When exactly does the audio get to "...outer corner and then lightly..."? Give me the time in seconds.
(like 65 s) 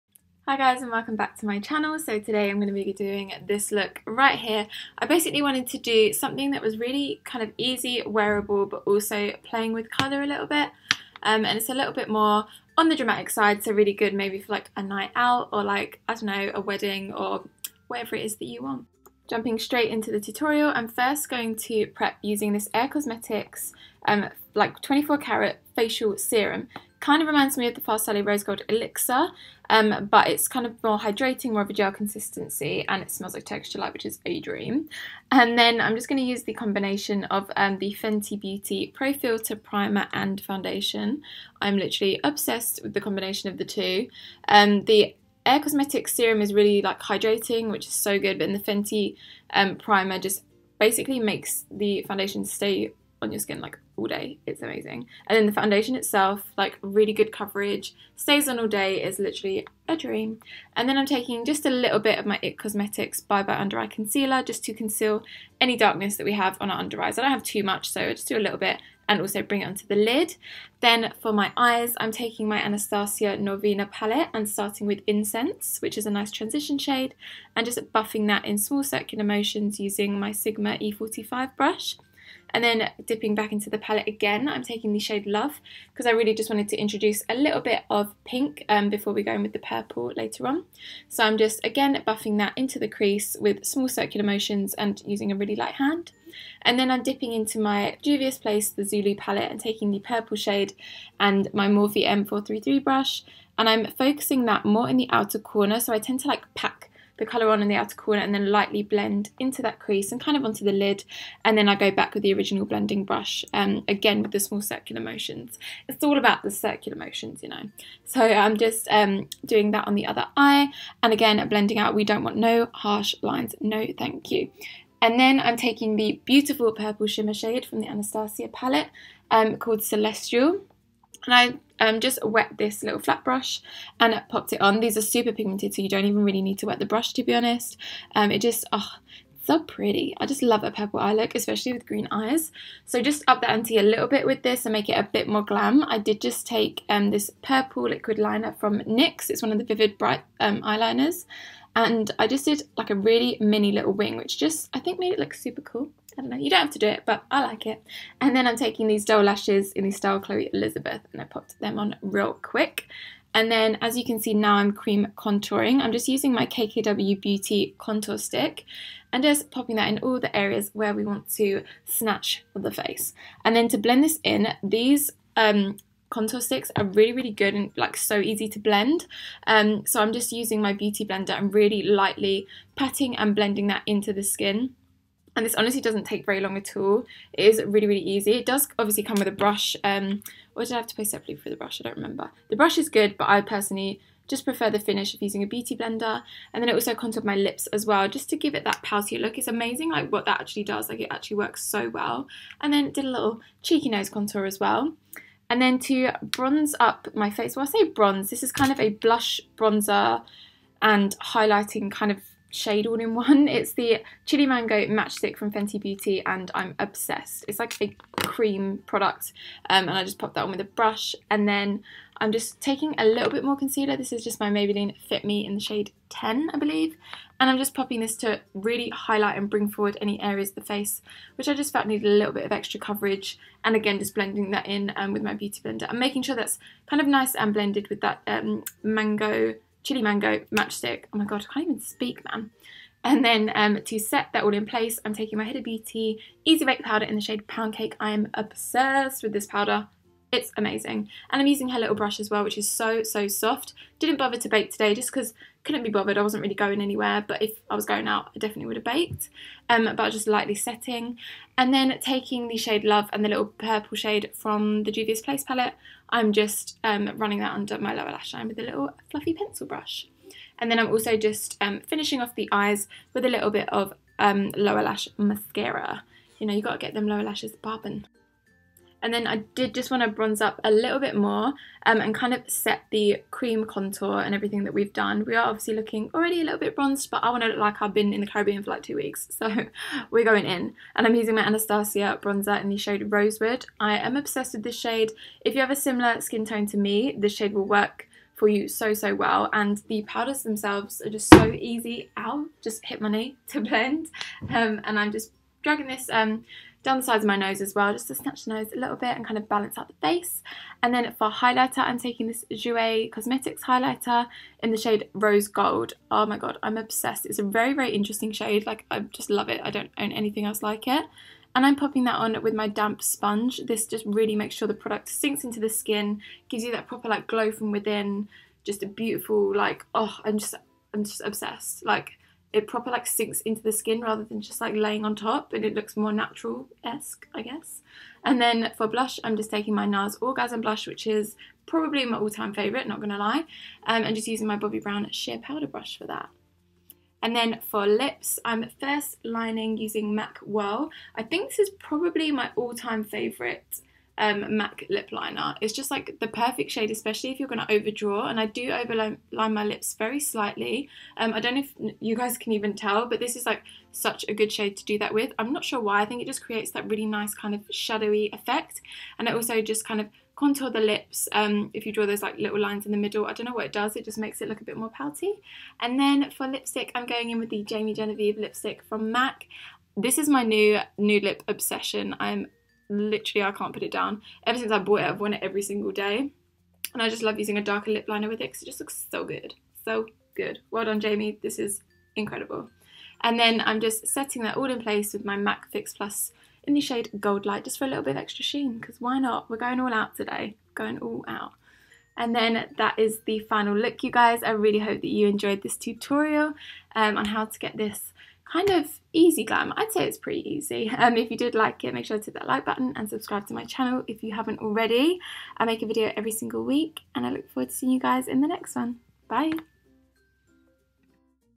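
107 s.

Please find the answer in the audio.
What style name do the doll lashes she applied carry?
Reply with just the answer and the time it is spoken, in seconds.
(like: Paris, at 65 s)
Chloe Elizabeth, at 160 s.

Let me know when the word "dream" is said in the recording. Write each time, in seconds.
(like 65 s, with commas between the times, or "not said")
34 s, 59 s.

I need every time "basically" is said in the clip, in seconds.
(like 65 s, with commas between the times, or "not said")
5 s, 50 s.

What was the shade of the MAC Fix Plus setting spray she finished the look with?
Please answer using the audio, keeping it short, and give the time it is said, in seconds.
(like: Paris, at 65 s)
Gold Light, at 397 s.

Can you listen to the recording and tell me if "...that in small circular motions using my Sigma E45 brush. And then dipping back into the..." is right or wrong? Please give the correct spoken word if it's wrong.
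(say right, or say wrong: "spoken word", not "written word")
right.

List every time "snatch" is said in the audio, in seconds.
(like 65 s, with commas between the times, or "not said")
171 s, 308 s.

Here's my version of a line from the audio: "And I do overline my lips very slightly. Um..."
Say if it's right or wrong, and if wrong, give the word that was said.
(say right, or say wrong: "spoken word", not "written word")
right.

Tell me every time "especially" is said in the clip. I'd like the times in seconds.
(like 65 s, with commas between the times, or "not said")
141 s, 356 s.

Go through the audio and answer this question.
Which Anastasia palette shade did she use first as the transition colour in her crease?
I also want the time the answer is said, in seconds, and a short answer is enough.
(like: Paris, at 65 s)
Incense, at 75 s.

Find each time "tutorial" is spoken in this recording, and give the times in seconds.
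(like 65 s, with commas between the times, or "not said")
20 s, 405 s.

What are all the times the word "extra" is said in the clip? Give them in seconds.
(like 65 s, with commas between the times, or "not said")
232 s, 398 s.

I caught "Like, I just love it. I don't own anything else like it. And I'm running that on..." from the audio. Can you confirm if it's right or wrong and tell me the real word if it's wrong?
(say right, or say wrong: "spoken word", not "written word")
wrong: "popping", not "running".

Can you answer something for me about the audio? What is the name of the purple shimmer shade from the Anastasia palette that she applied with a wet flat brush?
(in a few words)
Celestial.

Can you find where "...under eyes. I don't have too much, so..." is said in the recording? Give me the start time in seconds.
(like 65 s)
66 s.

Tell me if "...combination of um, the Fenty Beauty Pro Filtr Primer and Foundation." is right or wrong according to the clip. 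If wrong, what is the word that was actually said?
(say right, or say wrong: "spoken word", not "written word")
right.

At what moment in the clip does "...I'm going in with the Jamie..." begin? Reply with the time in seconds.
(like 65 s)
376 s.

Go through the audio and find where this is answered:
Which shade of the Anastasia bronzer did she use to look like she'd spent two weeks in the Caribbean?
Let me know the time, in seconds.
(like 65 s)
293 s.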